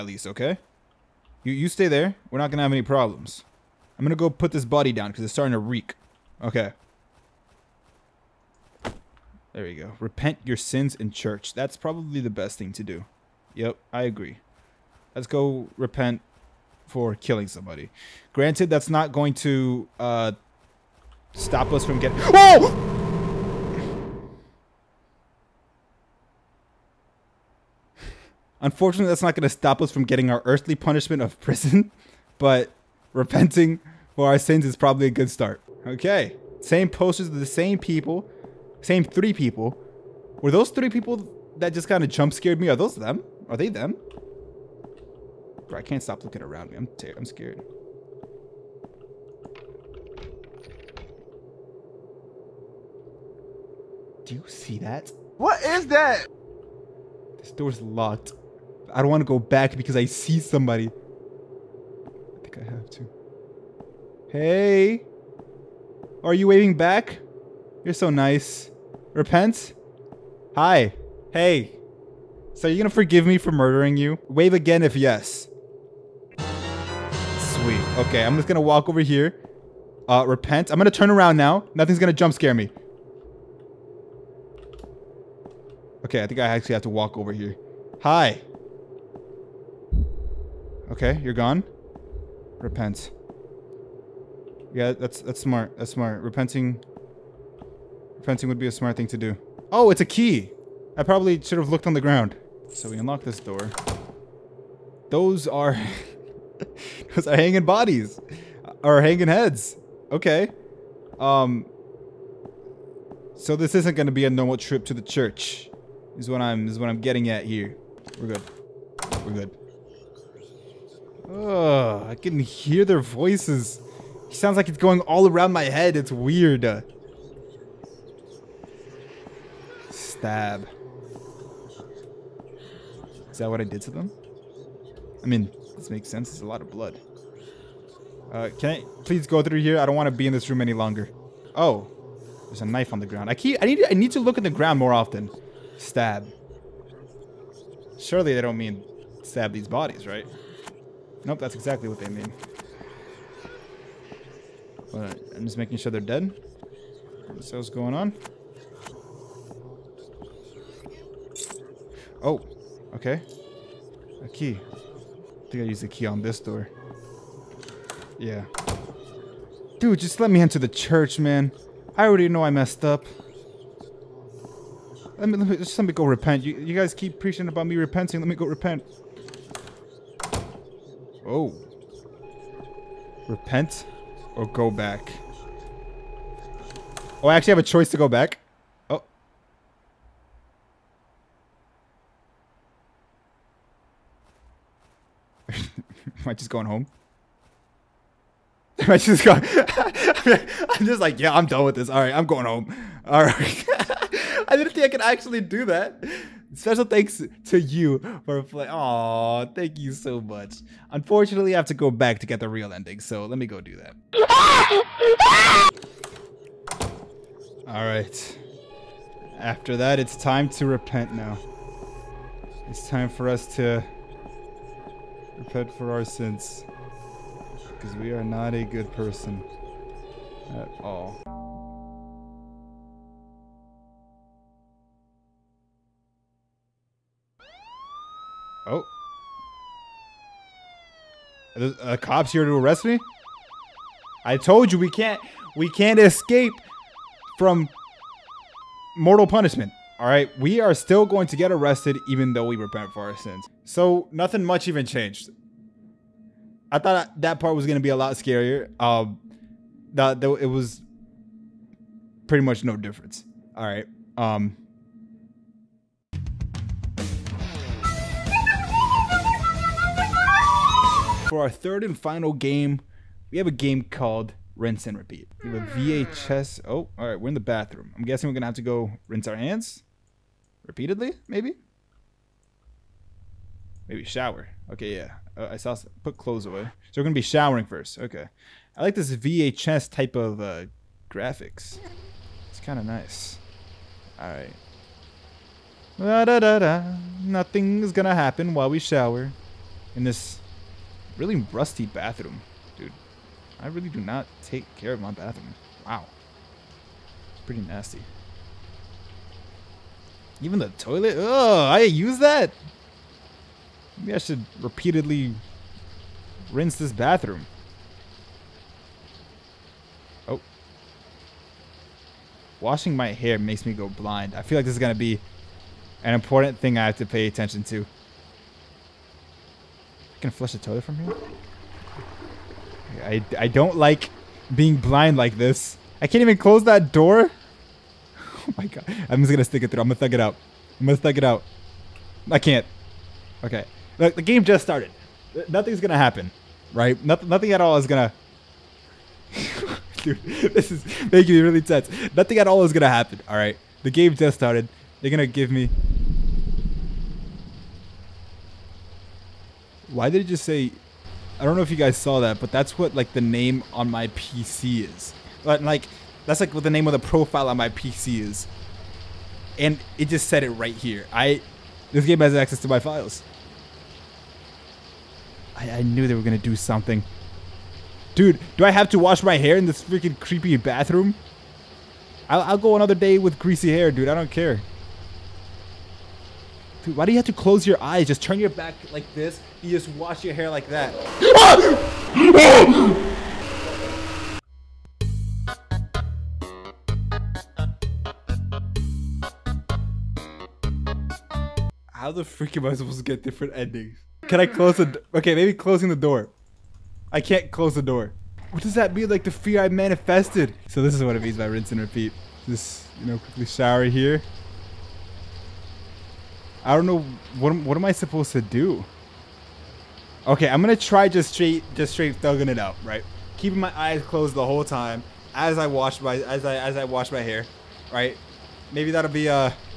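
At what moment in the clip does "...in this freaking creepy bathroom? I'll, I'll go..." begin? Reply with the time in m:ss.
6:19.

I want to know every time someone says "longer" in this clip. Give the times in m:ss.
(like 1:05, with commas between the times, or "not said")
2:20.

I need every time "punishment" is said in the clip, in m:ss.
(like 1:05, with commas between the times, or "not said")
0:30, 4:09.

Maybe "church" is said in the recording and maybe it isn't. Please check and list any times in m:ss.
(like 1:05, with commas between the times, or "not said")
0:11, 1:55, 2:50.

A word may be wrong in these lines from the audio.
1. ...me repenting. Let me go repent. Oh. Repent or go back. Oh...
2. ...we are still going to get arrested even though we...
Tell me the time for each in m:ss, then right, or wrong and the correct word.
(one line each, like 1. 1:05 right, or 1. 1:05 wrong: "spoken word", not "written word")
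1. 2:57 right
2. 4:10 right.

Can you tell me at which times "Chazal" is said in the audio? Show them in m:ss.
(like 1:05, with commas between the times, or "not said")
not said.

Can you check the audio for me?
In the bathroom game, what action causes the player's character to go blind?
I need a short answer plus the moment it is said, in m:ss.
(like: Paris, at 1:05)
Washing my hair, at 5:22.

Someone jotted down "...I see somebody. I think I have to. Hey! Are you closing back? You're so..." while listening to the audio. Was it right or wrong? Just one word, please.
wrong.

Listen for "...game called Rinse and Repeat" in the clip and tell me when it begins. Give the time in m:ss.
4:33.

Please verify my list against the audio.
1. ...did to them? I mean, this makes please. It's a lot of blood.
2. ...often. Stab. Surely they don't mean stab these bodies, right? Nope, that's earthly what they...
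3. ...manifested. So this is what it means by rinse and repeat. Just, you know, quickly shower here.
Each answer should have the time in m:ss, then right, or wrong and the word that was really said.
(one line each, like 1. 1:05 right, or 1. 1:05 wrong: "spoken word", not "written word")
1. 2:13 wrong: "sense", not "please"
2. 2:24 wrong: "exactly", not "earthly"
3. 6:49 right.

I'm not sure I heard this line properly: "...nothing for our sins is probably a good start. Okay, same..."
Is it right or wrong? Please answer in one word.
wrong.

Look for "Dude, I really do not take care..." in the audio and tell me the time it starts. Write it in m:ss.
5:02.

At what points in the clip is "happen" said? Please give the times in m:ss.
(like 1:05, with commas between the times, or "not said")
4:58, 5:45, 5:52.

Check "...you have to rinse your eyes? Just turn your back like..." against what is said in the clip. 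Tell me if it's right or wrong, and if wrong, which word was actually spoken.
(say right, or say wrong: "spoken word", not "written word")
wrong: "close", not "rinse".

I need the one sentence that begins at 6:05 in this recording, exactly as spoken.
But like that's like what the name of the profile on my PC is.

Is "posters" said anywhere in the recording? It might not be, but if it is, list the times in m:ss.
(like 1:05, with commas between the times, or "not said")
0:36.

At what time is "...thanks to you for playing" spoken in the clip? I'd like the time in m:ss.
3:26.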